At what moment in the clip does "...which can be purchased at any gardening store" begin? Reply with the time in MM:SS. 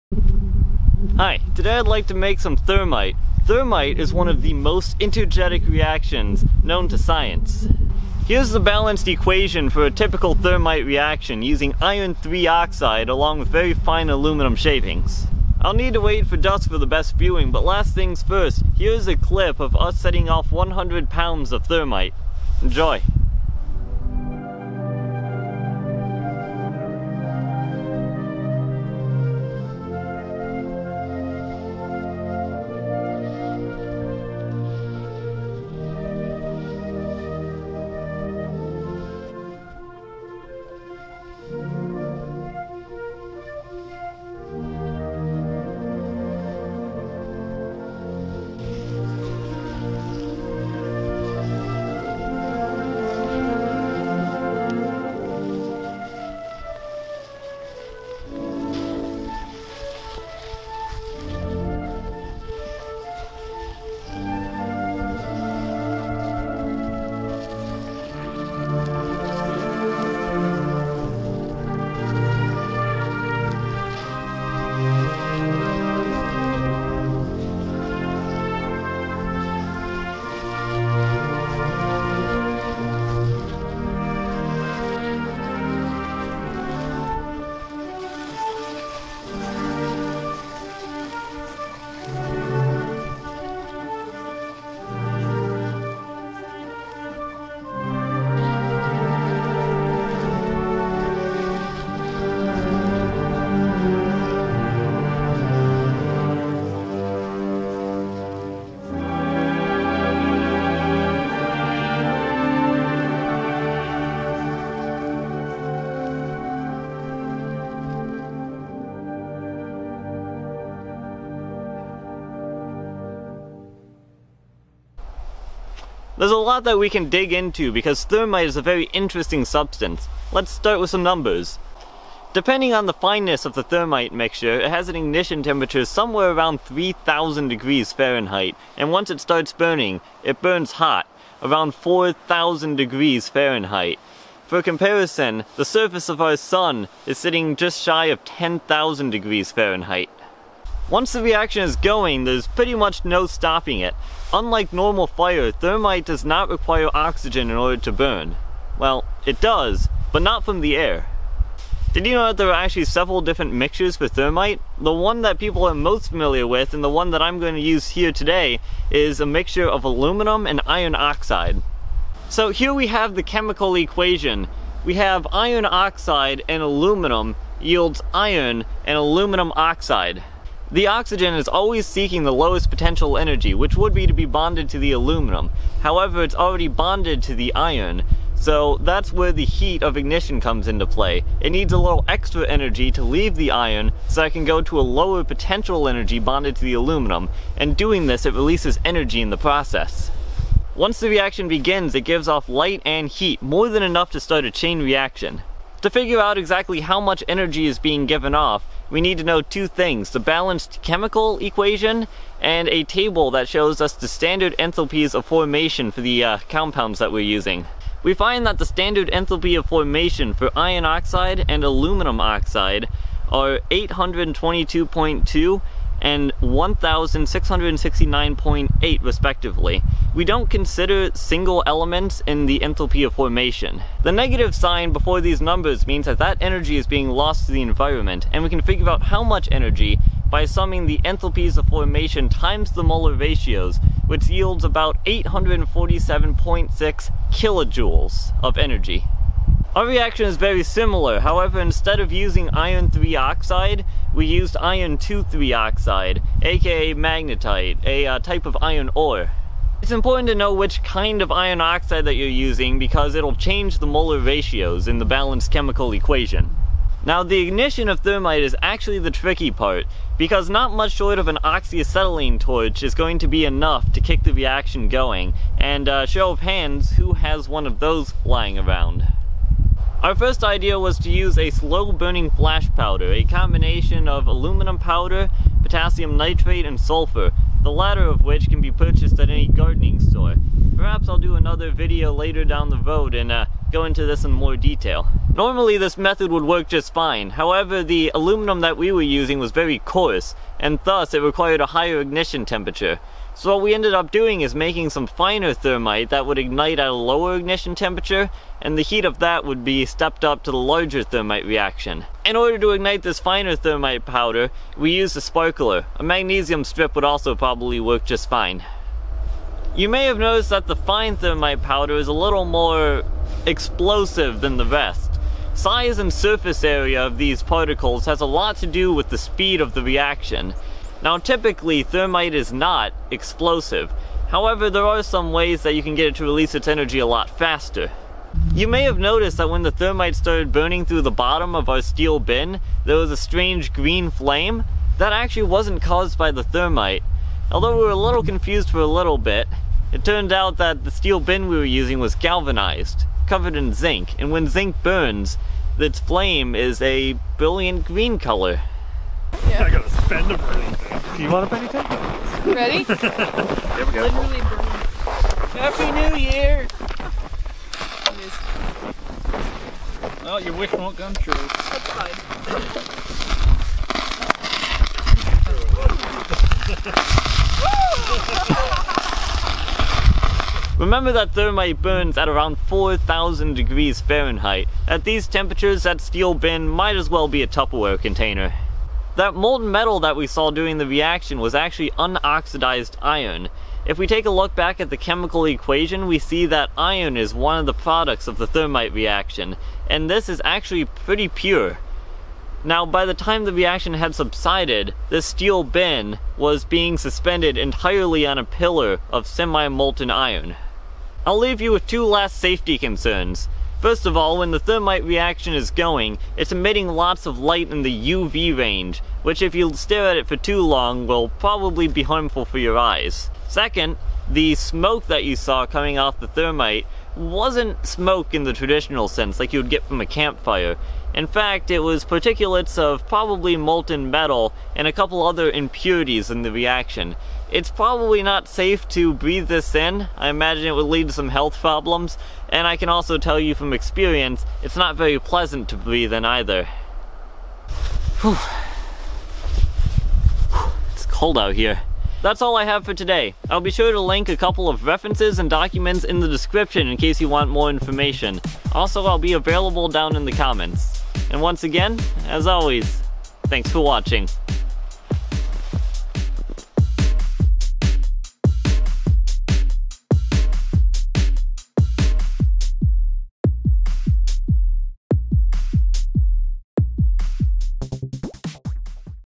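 04:48.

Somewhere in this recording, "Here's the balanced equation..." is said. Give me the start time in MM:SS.
00:08.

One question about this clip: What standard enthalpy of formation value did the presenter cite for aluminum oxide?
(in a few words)
1669.8.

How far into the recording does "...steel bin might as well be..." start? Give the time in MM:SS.
06:26.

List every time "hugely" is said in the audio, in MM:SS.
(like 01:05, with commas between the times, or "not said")
not said.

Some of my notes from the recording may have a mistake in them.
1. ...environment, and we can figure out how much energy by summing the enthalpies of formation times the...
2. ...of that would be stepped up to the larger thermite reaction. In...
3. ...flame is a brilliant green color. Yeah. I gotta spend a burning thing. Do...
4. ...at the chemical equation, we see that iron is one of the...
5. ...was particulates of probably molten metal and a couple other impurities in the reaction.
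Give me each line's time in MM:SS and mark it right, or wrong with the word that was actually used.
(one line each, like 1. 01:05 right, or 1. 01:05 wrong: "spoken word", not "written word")
1. 03:57 right
2. 05:09 right
3. 05:56 right
4. 06:34 right
5. 07:11 right.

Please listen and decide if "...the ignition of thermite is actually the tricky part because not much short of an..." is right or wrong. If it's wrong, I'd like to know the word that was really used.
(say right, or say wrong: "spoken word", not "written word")
right.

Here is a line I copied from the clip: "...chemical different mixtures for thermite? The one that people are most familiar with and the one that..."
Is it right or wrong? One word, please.
wrong.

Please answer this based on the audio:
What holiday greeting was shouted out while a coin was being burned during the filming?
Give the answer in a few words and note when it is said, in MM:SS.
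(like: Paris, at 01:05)
Happy New Year, at 06:05.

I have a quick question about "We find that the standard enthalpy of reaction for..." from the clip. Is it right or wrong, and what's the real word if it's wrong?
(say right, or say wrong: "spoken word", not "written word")
wrong: "formation", not "reaction".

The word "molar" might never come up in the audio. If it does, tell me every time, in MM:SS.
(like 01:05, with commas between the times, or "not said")
04:02, 04:23.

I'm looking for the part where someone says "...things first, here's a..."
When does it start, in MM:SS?
00:17.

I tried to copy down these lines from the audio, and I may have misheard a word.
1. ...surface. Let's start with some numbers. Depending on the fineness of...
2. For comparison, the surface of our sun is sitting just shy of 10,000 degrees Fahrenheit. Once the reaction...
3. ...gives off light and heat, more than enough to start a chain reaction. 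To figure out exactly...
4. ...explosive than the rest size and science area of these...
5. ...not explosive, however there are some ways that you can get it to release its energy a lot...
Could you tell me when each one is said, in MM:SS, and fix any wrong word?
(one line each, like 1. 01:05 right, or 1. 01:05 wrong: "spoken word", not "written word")
1. 02:09 wrong: "substance", not "surface"
2. 02:24 right
3. 03:22 right
4. 05:23 wrong: "surface", not "science"
5. 05:32 right.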